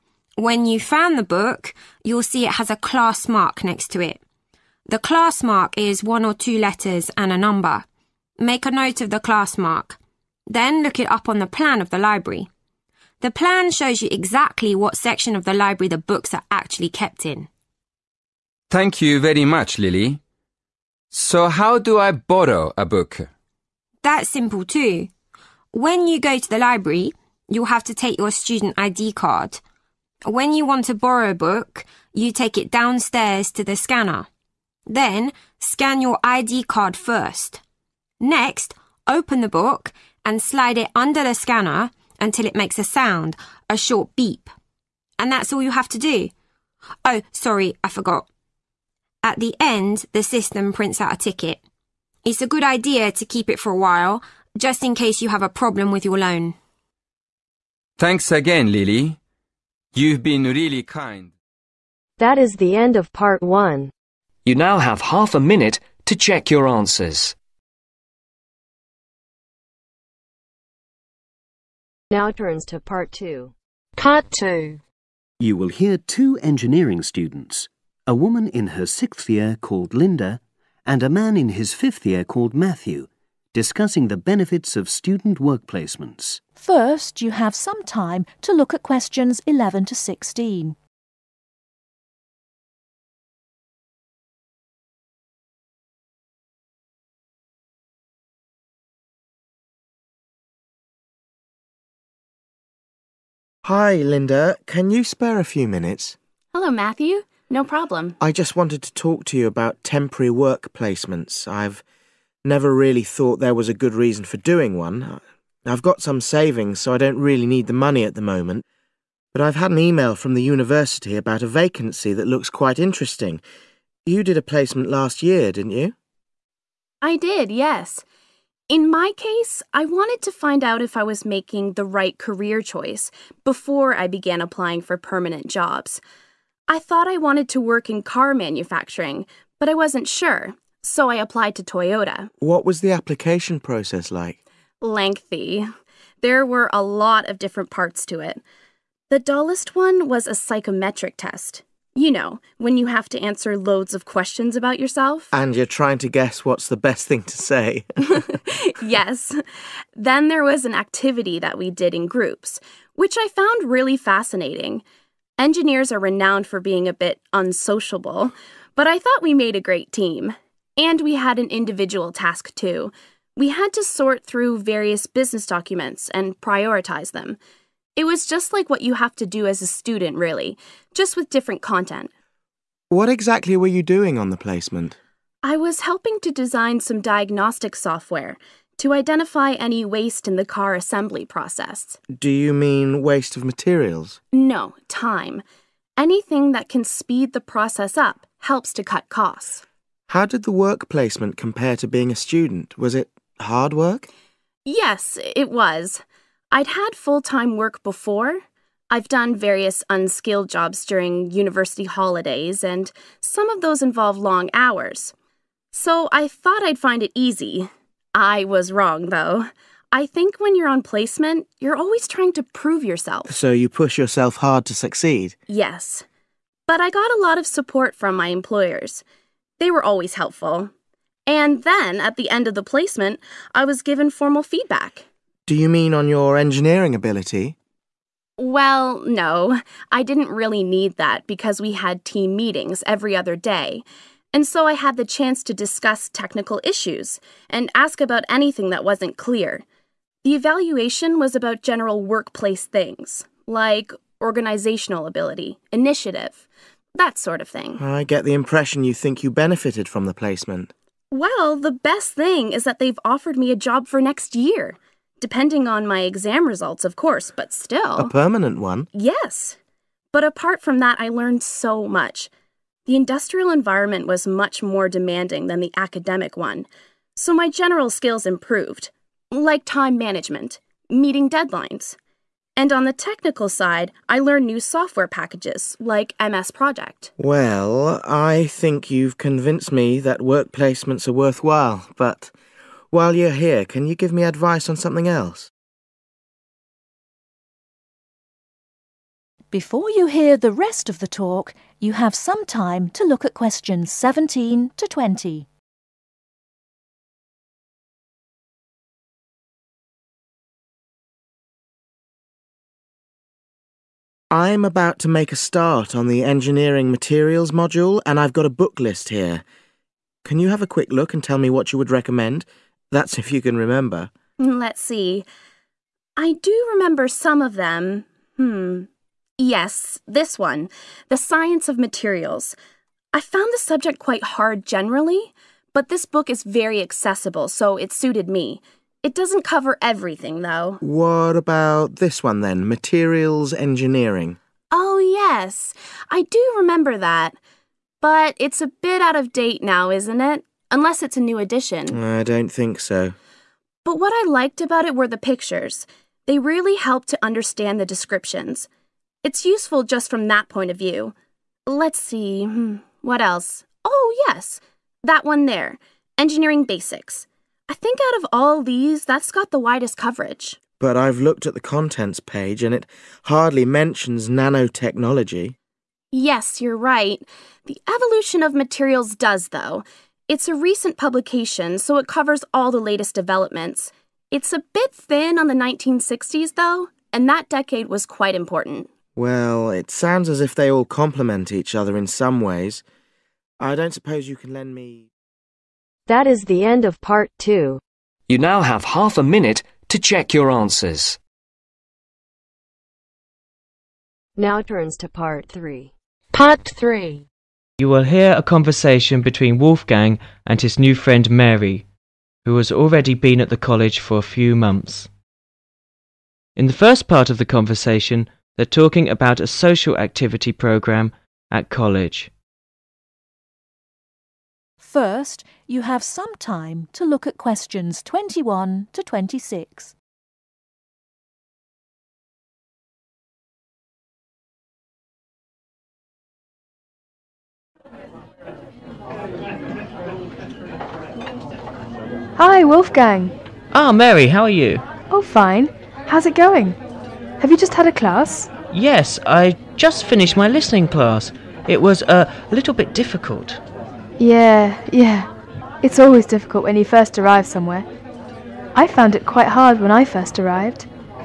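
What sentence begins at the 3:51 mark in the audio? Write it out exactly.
And then, at the end of the placement, I was given formal feedback.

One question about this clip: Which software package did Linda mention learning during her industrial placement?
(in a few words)
MS Project.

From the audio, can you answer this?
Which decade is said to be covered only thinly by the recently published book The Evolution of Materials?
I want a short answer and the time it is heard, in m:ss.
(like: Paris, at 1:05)
The 1960s, at 6:25.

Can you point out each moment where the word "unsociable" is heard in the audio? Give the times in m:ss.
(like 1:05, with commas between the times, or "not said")
2:47.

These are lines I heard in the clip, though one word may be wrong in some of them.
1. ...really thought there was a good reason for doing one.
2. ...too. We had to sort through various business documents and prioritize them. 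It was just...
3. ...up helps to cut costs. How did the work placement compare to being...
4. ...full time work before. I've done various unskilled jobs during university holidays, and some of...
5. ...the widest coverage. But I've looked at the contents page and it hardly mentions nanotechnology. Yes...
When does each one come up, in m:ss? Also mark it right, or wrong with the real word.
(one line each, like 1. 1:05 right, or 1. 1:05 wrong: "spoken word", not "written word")
1. 1:52 right
2. 2:52 right
3. 3:17 right
4. 3:26 right
5. 6:09 right.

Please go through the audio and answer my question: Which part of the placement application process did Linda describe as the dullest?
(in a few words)
A psychometric test.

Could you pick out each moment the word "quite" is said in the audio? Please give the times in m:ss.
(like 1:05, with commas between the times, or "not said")
2:02, 5:34, 6:28, 7:39.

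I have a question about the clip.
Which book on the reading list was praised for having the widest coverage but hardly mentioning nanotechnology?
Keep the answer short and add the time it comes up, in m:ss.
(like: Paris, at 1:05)
Engineering Basics, at 6:06.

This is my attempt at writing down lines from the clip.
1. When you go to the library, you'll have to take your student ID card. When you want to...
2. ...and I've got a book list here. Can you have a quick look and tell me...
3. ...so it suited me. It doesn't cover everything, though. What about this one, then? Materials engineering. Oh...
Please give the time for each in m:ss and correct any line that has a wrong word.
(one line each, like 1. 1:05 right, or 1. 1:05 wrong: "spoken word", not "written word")
1. 0:25 right
2. 5:18 right
3. 5:37 right.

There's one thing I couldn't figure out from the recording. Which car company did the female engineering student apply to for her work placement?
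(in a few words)
Toyota.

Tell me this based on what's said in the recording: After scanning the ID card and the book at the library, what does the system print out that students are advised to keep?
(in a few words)
A ticket.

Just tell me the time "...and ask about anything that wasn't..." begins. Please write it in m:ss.
4:07.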